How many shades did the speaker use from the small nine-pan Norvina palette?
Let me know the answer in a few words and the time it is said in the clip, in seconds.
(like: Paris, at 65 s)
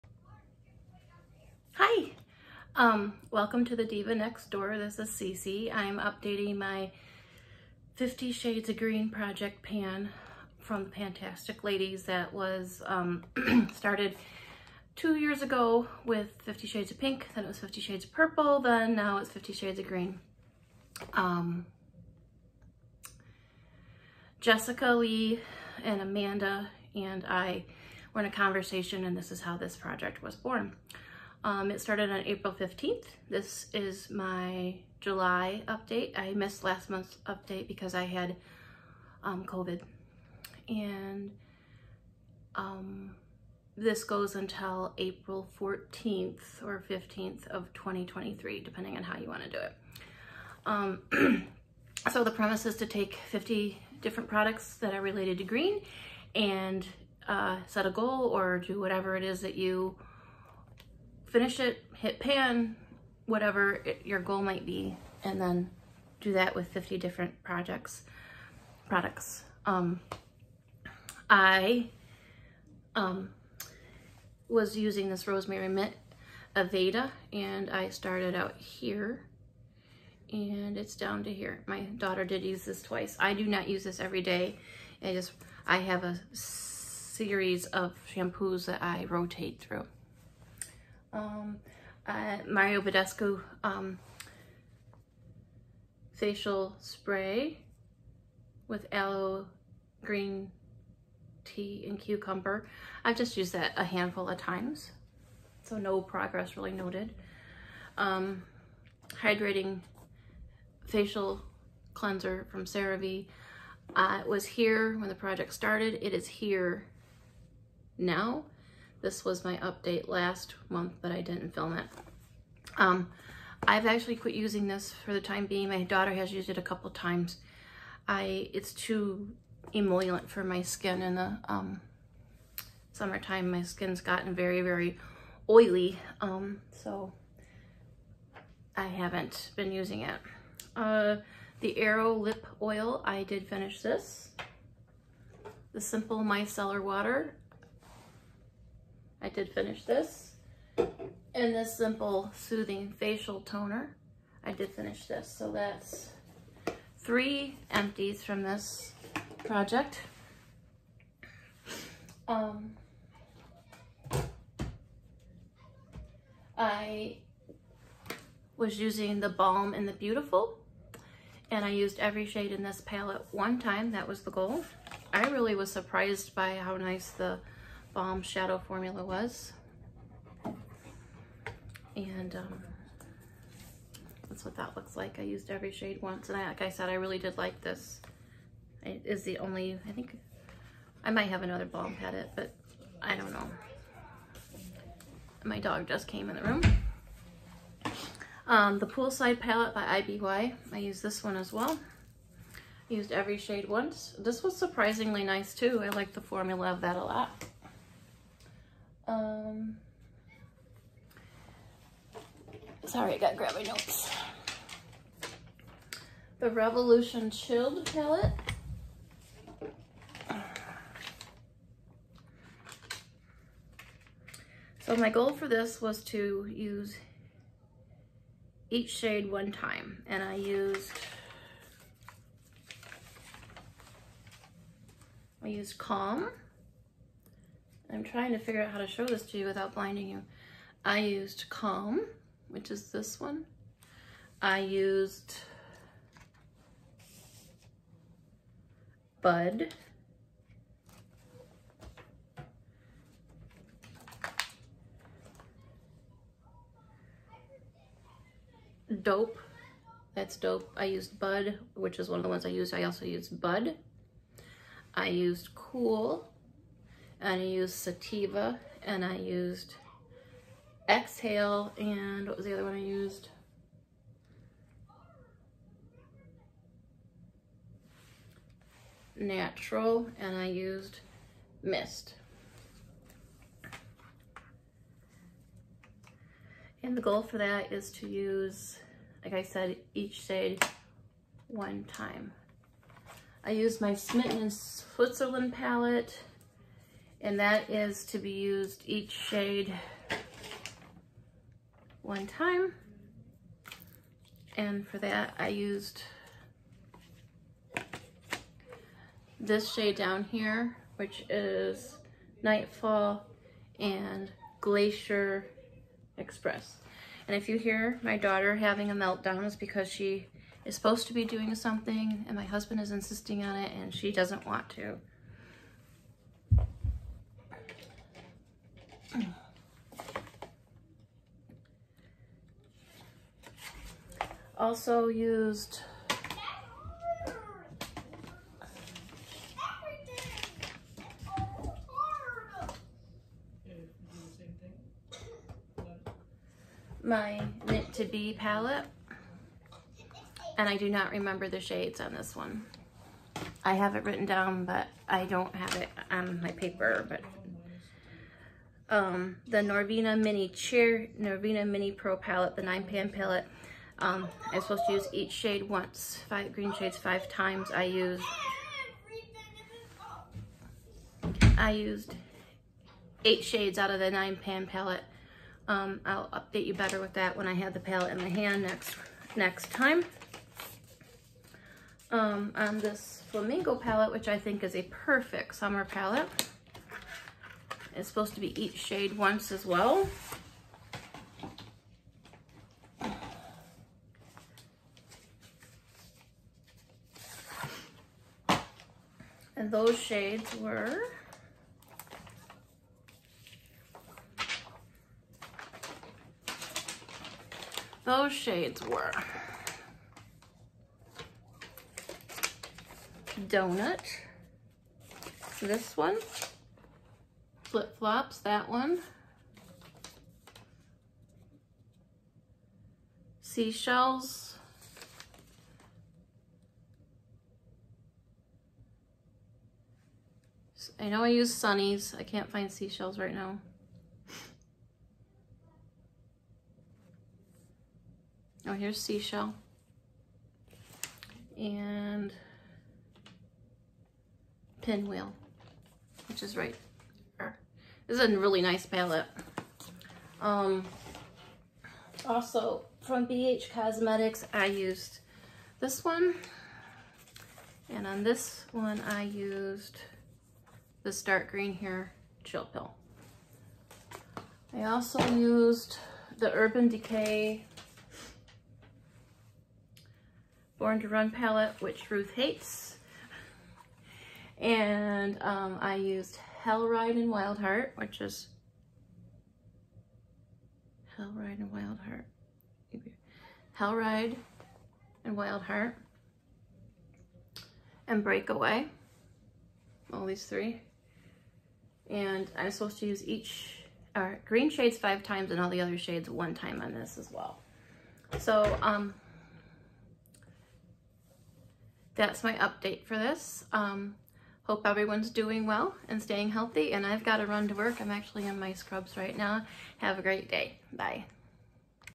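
8, at 373 s.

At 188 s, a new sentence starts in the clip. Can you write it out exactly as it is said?
It is the only, I think, I might have another balm palette, but I don't know.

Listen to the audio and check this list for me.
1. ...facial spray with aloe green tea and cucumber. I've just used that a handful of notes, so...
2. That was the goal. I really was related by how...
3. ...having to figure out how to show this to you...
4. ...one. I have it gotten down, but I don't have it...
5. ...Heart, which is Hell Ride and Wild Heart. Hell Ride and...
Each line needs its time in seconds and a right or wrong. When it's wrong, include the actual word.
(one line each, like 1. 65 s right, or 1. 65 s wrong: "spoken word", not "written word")
1. 96 s wrong: "times", not "notes"
2. 173 s wrong: "surprised", not "related"
3. 238 s wrong: "trying", not "having"
4. 352 s wrong: "written", not "gotten"
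5. 477 s right.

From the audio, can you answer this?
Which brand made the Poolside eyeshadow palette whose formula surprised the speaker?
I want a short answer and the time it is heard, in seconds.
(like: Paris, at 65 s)
IBY, at 200 s.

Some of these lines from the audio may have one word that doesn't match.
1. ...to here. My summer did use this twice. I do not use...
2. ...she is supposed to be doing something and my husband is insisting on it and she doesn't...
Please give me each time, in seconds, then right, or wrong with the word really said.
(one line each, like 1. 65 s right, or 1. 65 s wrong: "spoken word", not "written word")
1. 81 s wrong: "daughter", not "summer"
2. 319 s right.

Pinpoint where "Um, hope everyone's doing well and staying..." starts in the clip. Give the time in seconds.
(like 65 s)
503 s.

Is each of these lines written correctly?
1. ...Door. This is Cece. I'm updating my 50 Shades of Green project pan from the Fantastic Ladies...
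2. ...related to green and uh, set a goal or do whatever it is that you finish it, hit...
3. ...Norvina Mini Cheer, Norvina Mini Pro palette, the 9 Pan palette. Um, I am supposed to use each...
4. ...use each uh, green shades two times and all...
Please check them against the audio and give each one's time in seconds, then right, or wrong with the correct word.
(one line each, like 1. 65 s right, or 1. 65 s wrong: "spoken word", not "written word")
1. 4 s right
2. 55 s right
3. 359 s right
4. 493 s wrong: "five", not "two".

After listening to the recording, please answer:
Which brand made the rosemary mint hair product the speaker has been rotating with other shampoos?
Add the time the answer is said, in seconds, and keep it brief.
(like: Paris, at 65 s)
Aveda, at 76 s.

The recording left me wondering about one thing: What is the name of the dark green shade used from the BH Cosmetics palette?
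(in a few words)
Chill Pill.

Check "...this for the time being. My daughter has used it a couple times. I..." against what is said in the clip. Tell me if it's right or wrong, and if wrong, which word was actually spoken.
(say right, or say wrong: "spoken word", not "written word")
right.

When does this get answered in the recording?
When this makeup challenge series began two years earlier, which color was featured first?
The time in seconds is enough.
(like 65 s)
16 s.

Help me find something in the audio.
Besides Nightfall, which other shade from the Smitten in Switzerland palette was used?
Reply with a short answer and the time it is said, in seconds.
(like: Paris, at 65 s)
Glacier Express, at 314 s.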